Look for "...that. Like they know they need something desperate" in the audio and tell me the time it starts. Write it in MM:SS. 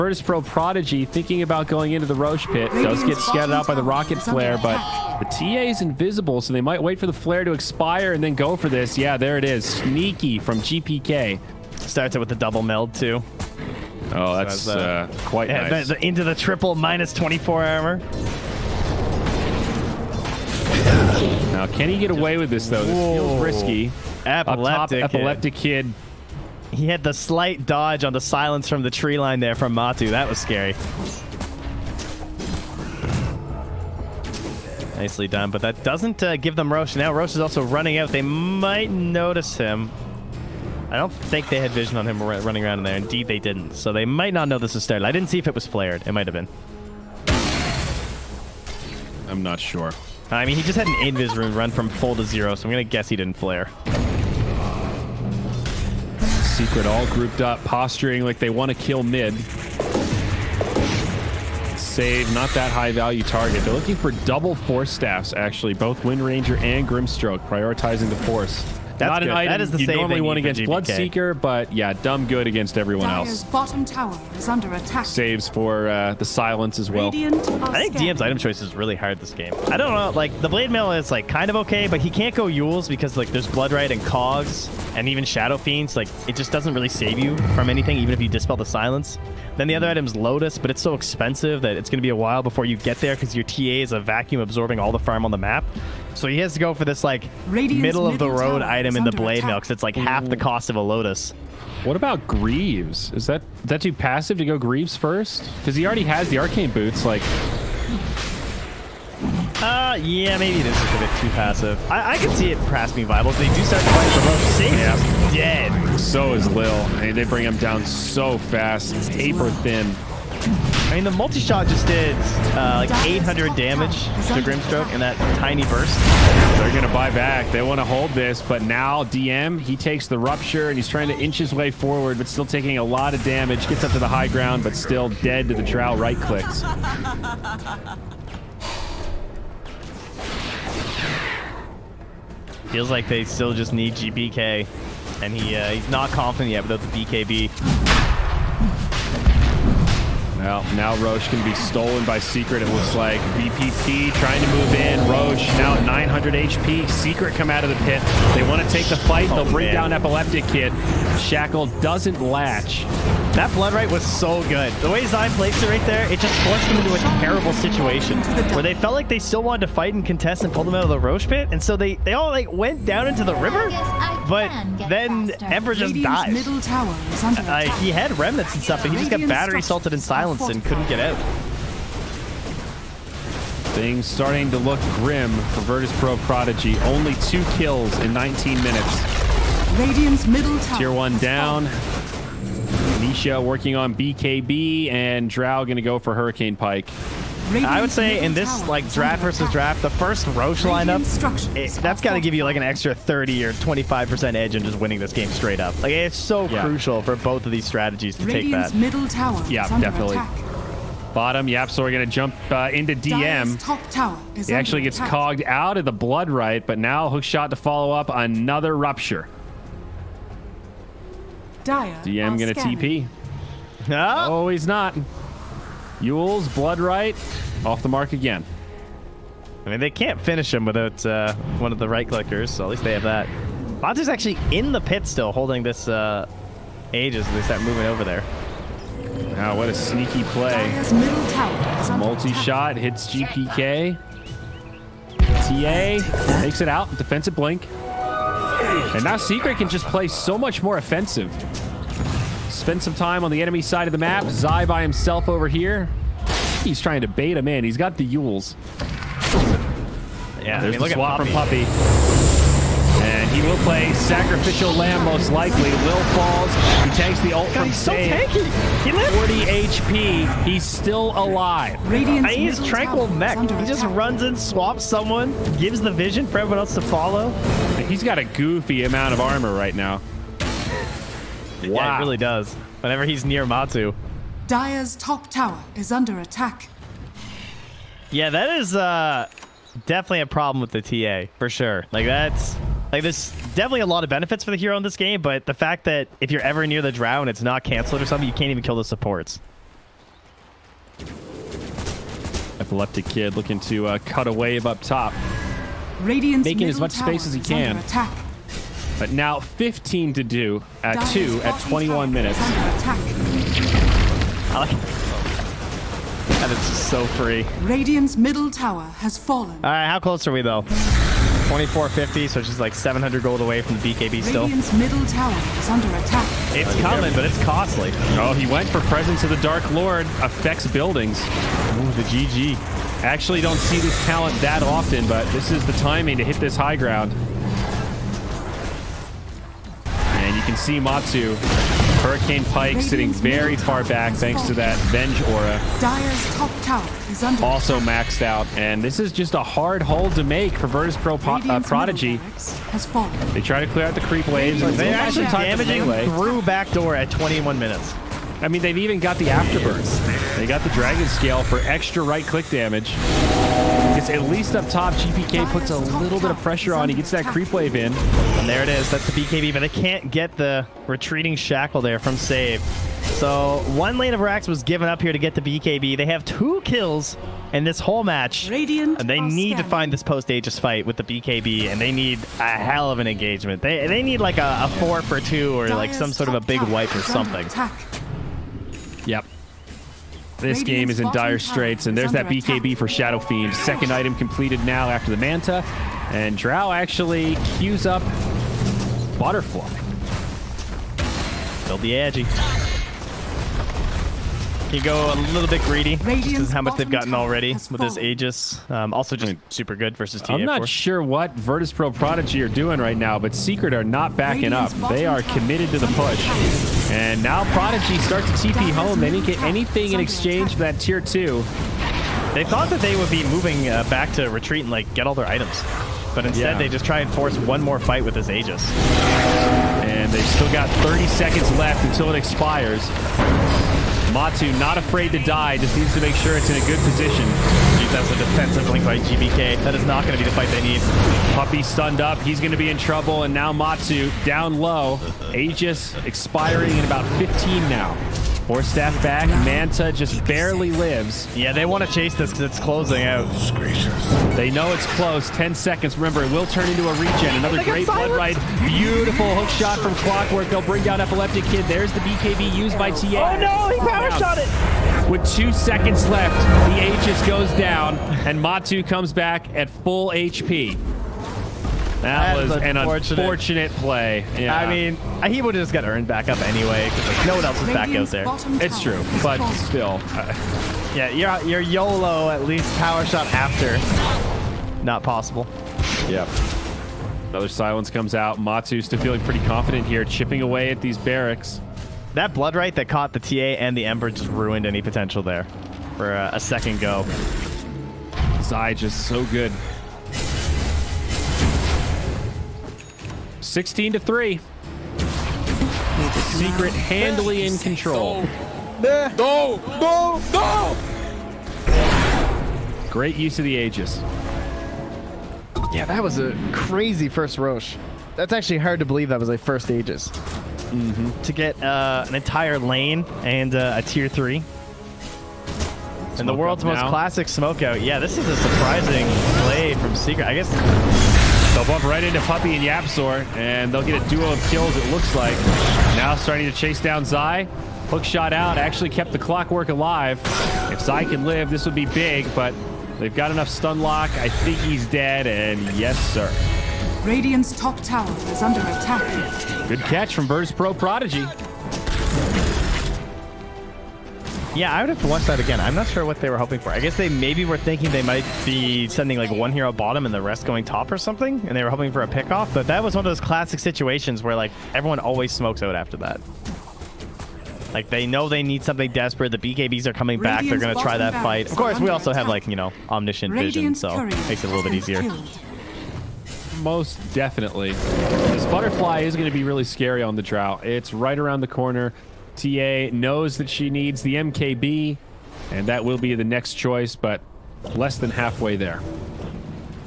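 09:25.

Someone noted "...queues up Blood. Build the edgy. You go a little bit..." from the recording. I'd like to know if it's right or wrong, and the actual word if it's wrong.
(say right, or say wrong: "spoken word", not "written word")
wrong: "Butterfly", not "Blood".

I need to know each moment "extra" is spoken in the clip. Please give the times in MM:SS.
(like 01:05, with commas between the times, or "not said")
03:22, 06:01.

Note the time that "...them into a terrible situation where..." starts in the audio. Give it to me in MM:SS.
02:46.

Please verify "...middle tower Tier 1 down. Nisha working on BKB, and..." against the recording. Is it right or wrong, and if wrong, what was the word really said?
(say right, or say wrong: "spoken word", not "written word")
right.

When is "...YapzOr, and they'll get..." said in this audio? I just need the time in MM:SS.
08:52.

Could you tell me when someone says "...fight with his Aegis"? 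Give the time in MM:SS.
07:07.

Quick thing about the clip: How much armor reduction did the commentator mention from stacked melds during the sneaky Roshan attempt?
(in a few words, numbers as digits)
triple minus 24 armor.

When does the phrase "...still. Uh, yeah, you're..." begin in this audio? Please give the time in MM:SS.
07:59.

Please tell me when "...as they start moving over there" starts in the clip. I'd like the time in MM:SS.
03:57.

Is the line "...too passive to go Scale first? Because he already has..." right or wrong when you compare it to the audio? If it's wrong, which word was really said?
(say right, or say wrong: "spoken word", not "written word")
wrong: "Greaves", not "Scale".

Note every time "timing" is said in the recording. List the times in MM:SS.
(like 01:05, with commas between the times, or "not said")
05:35.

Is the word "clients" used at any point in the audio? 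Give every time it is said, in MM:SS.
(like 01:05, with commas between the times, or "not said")
not said.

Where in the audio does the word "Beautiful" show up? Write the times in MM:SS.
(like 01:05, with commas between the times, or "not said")
07:38.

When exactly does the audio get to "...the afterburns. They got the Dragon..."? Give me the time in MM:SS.
05:59.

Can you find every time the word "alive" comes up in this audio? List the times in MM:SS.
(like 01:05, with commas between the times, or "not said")
04:31, 08:59.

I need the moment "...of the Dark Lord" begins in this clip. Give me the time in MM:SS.
05:29.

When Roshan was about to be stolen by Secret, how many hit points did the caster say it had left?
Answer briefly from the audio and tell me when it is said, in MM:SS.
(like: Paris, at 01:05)
900, at 02:35.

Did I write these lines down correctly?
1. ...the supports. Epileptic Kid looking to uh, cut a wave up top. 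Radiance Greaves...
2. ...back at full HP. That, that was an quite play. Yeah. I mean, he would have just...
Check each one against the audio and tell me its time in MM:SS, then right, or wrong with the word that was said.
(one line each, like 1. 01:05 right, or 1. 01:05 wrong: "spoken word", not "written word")
1. 04:58 wrong: "Making", not "Greaves"
2. 07:49 wrong: "unfortunate", not "quite".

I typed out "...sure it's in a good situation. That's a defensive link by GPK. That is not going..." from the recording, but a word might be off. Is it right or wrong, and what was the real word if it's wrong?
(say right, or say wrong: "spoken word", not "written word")
wrong: "position", not "situation".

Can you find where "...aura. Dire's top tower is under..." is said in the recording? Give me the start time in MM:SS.
05:45.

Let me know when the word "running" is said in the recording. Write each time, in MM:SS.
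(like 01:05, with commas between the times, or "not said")
00:37, 00:42.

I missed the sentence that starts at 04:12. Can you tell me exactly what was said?
Spend some time on the enemy side of the map.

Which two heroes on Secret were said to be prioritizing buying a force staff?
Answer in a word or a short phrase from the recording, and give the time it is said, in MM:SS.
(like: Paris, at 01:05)
Wind Ranger and Grimstroke, at 01:06.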